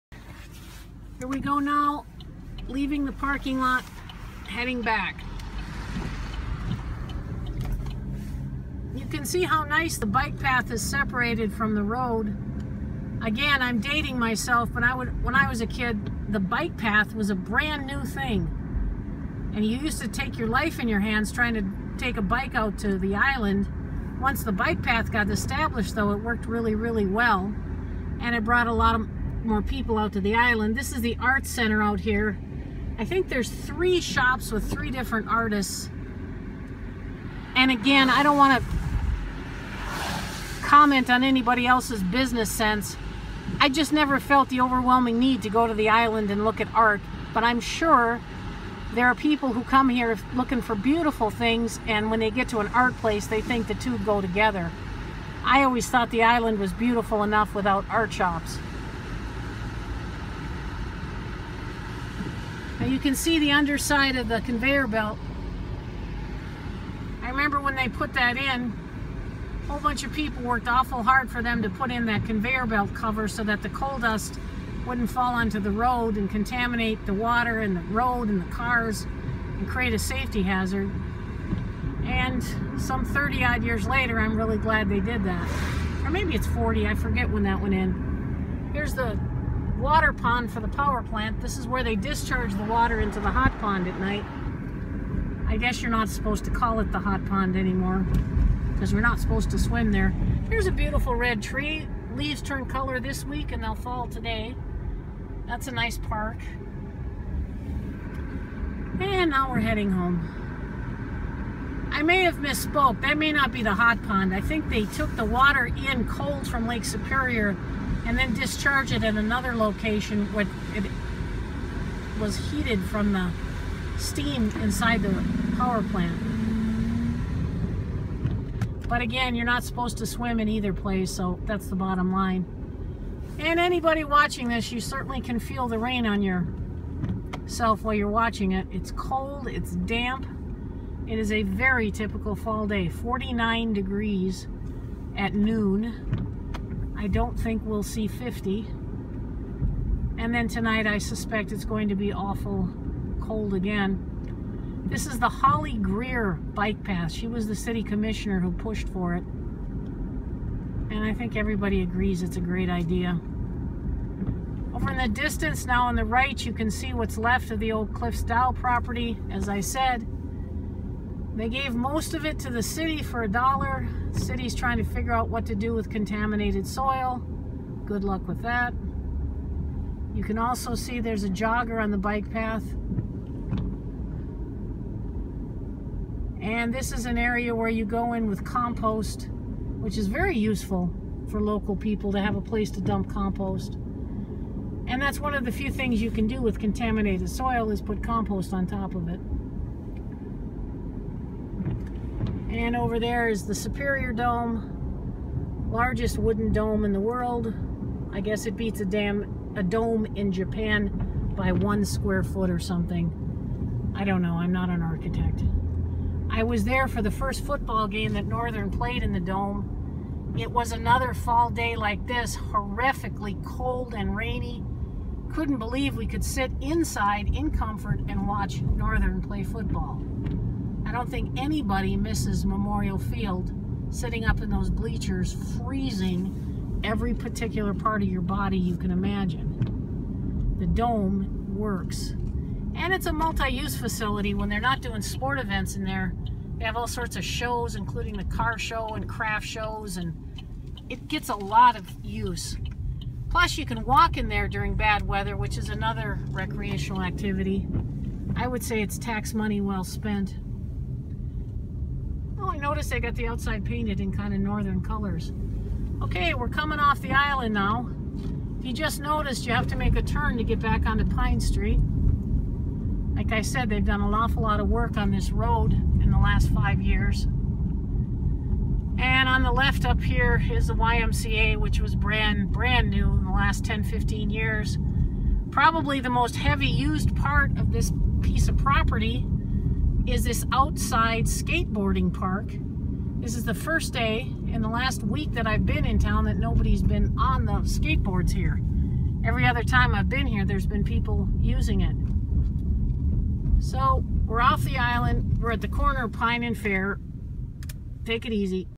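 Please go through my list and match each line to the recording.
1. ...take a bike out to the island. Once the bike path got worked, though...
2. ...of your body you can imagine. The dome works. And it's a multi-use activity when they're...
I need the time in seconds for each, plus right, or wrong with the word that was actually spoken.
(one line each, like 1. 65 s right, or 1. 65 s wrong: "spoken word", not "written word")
1. 22 s wrong: "established", not "worked"
2. 238 s wrong: "facility", not "activity".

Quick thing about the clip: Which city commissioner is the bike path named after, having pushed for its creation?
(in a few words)
Holly Greer.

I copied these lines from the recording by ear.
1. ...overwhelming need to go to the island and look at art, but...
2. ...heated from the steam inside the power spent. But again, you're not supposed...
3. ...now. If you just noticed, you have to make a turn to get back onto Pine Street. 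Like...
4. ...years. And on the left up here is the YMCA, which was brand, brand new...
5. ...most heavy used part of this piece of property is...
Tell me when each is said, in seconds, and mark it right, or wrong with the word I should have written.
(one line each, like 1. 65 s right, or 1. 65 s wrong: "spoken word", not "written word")
1. 44 s right
2. 122 s wrong: "plant", not "spent"
3. 267 s right
4. 276 s right
5. 286 s right.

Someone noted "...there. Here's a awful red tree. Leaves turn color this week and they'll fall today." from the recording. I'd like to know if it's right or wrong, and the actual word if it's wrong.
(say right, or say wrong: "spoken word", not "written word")
wrong: "beautiful", not "awful".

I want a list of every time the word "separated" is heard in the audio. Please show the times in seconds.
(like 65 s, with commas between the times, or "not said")
10 s.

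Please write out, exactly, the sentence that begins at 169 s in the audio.
As I said, they gave most of it to the city for a dollar.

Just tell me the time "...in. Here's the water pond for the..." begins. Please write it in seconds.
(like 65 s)
87 s.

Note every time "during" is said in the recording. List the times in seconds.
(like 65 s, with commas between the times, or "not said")
254 s.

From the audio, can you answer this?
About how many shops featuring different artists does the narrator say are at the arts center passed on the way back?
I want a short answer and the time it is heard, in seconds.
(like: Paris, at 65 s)
3, at 33 s.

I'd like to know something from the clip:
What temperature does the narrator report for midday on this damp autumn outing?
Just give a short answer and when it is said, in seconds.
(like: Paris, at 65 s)
49 degrees, at 142 s.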